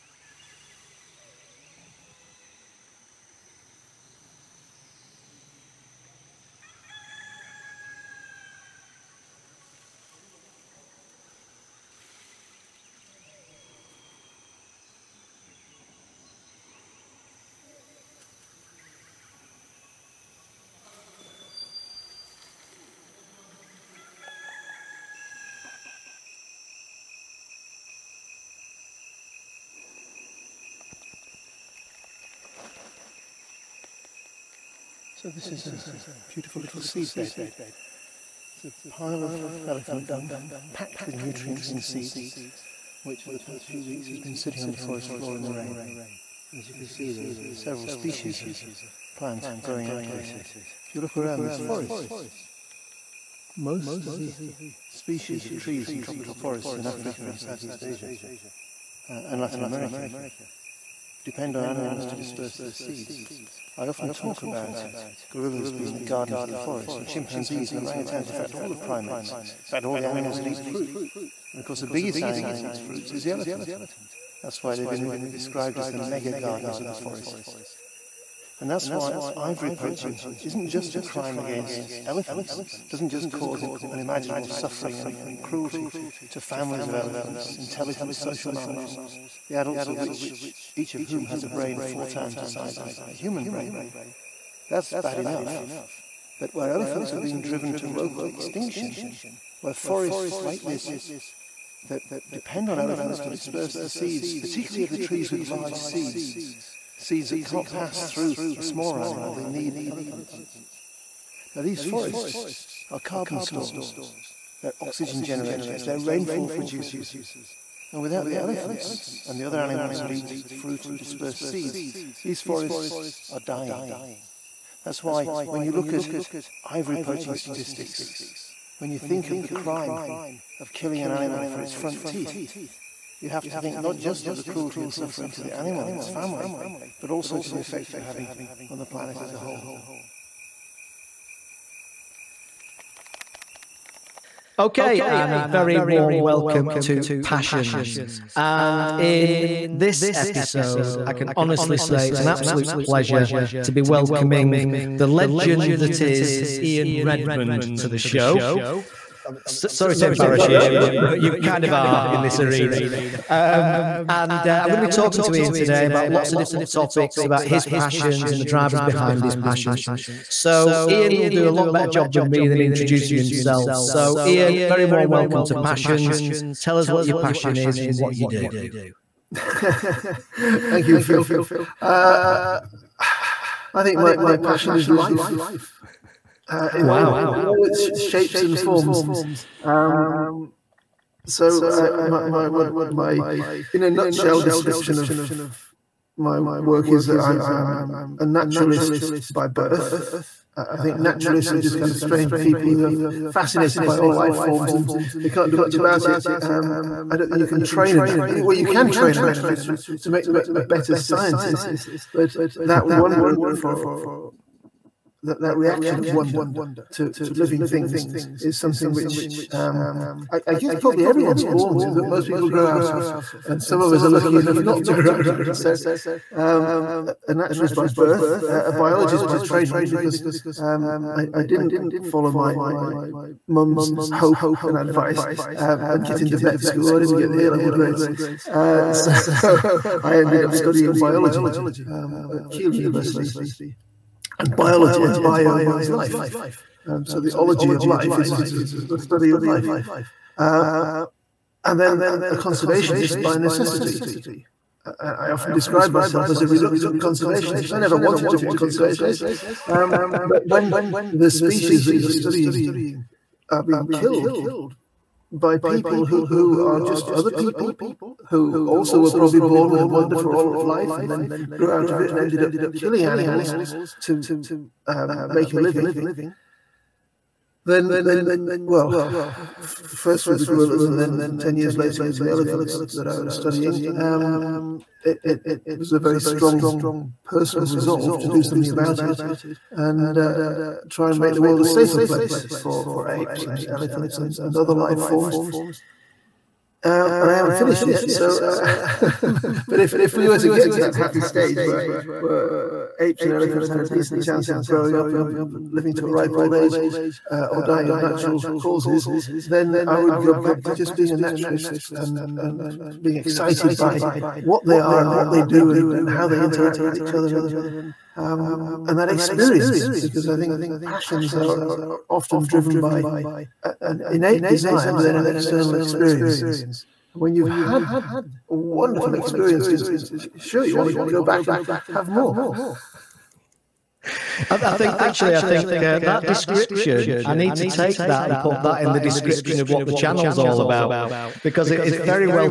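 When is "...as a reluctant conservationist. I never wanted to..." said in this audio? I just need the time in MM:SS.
04:16.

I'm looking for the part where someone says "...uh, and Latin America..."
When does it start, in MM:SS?
00:59.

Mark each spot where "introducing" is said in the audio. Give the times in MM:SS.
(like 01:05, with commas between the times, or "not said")
02:52.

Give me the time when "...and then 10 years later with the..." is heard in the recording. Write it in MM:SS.
04:40.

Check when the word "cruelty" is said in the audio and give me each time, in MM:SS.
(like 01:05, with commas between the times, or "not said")
01:25, 02:14.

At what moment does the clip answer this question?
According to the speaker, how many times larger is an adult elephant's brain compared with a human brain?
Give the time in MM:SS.
01:31.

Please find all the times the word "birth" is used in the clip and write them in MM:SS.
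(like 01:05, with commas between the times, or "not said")
03:19, 03:47.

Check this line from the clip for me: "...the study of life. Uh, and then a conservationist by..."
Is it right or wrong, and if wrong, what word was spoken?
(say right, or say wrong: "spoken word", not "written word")
right.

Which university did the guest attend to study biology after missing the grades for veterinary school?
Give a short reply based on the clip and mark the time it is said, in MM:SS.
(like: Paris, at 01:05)
Keele University, at 04:02.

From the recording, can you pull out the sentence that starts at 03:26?
Um, I don't think you can train an natural.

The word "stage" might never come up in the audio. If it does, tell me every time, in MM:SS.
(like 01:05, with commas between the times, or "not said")
05:01.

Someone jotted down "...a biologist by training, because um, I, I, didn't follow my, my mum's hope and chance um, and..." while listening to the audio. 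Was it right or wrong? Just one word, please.
wrong.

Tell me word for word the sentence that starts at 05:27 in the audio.
And when you've had wonderful experiences, sure, you want to go back and have more.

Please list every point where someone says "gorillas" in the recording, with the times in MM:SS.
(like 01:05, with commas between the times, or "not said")
01:05, 04:40.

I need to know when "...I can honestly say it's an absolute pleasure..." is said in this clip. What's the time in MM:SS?
02:31.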